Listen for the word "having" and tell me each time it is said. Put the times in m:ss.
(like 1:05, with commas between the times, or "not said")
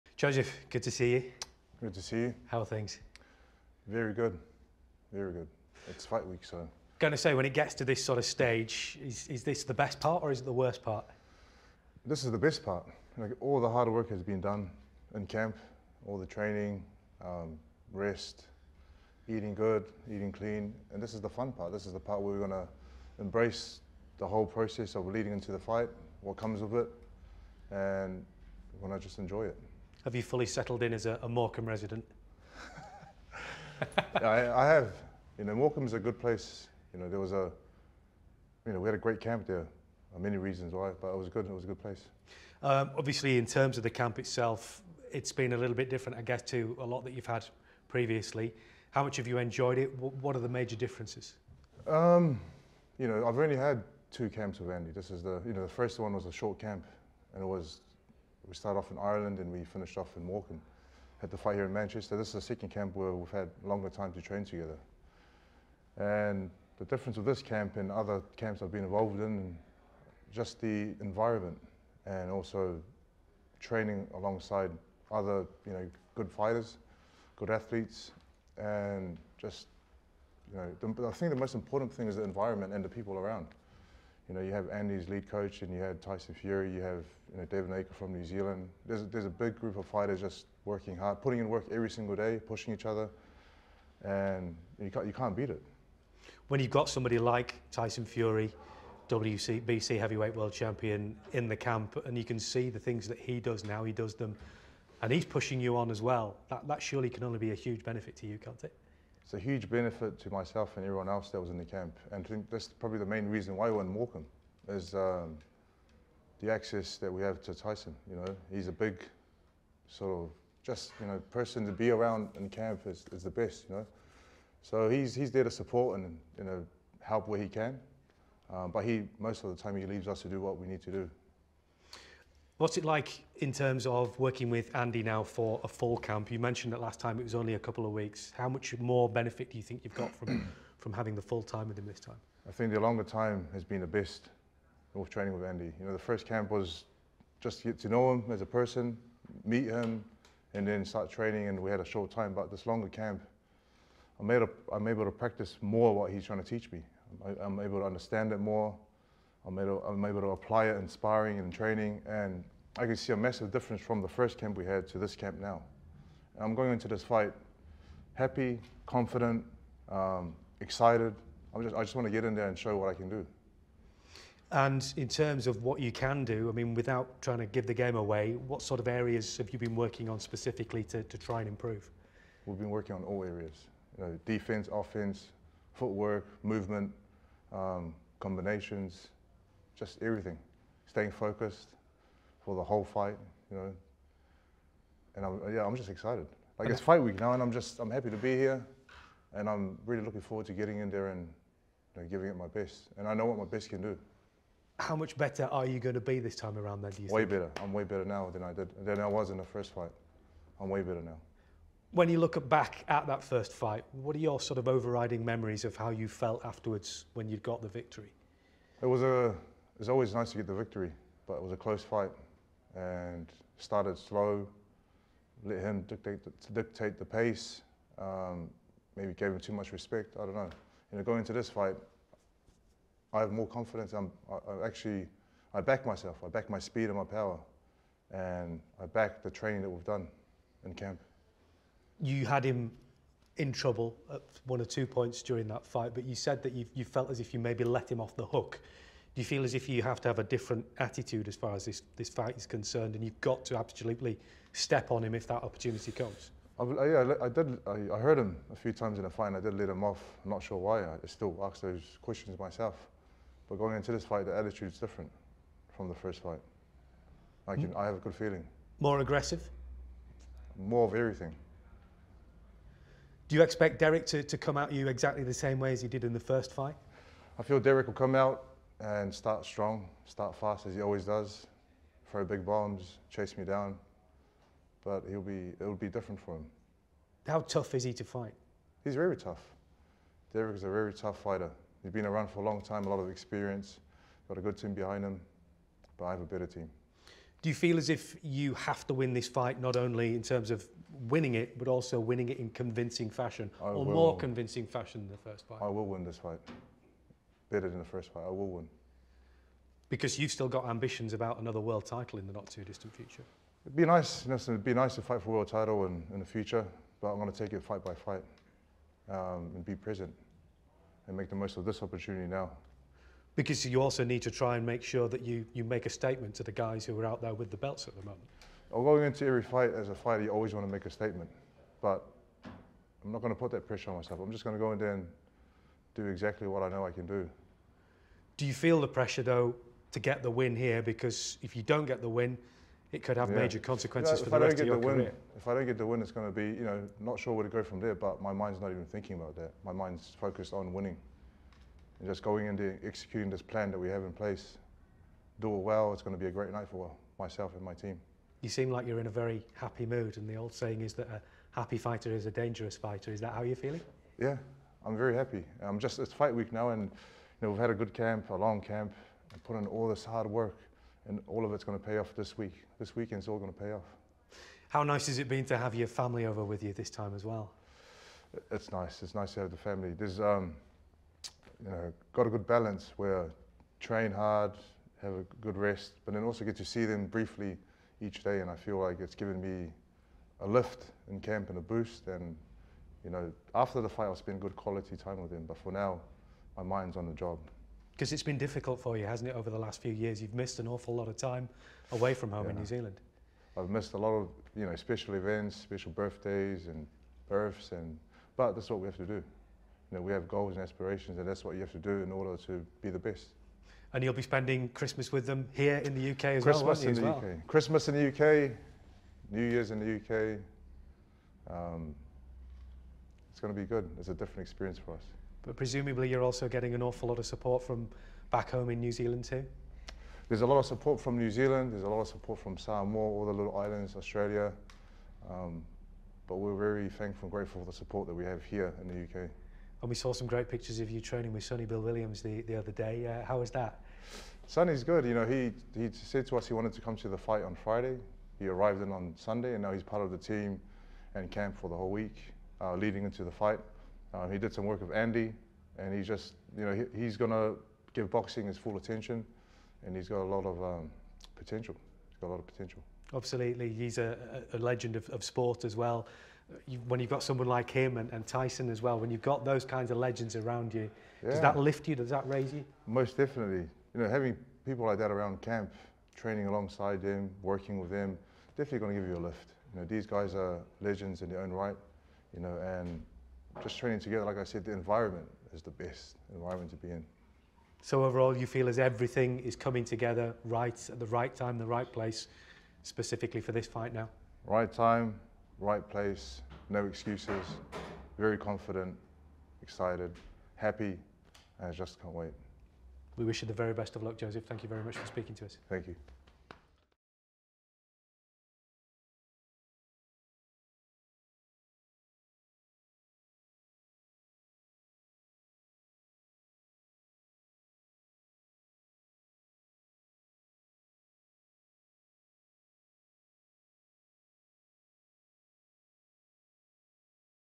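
2:20, 7:54.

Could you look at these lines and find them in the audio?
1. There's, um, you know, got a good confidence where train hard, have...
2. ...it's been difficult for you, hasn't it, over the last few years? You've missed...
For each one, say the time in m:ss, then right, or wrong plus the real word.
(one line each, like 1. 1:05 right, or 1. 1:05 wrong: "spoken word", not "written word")
1. 6:19 wrong: "balance", not "confidence"
2. 6:38 right.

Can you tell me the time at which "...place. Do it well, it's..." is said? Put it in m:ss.
5:54.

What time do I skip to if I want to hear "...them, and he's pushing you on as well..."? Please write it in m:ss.
1:44.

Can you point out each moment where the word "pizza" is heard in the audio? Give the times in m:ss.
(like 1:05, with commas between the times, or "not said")
not said.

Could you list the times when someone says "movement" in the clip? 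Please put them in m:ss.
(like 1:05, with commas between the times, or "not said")
3:06.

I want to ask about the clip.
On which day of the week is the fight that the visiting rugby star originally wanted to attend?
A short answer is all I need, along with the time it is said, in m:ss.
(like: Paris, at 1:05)
Friday, at 7:27.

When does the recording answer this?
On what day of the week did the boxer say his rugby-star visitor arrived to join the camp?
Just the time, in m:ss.
7:29.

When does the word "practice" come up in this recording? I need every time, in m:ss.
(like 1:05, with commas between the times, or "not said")
2:35.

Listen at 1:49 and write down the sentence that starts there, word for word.
it's a huge benefit to myself and everyone else that was in the camp.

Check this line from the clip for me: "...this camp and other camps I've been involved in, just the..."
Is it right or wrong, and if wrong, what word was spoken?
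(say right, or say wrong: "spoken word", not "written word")
right.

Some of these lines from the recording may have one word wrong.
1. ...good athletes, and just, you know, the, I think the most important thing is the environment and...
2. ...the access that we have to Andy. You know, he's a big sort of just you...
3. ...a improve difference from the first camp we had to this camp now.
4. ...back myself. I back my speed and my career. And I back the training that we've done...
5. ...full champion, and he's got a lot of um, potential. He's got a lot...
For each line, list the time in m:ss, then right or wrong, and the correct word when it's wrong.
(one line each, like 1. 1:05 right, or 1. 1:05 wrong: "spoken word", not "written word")
1. 1:17 right
2. 1:56 wrong: "Tyson", not "Andy"
3. 2:43 wrong: "massive", not "improve"
4. 3:55 wrong: "power", not "career"
5. 7:38 wrong: "attention", not "champion".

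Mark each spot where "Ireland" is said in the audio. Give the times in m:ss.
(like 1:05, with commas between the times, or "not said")
0:58.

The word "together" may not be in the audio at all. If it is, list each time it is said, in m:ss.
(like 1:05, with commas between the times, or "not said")
1:04, 8:03, 8:09.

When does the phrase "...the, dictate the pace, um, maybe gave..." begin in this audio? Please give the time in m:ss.
3:46.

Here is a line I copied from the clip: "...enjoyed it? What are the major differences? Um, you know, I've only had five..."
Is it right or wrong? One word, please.
wrong.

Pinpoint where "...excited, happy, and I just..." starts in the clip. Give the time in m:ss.
8:19.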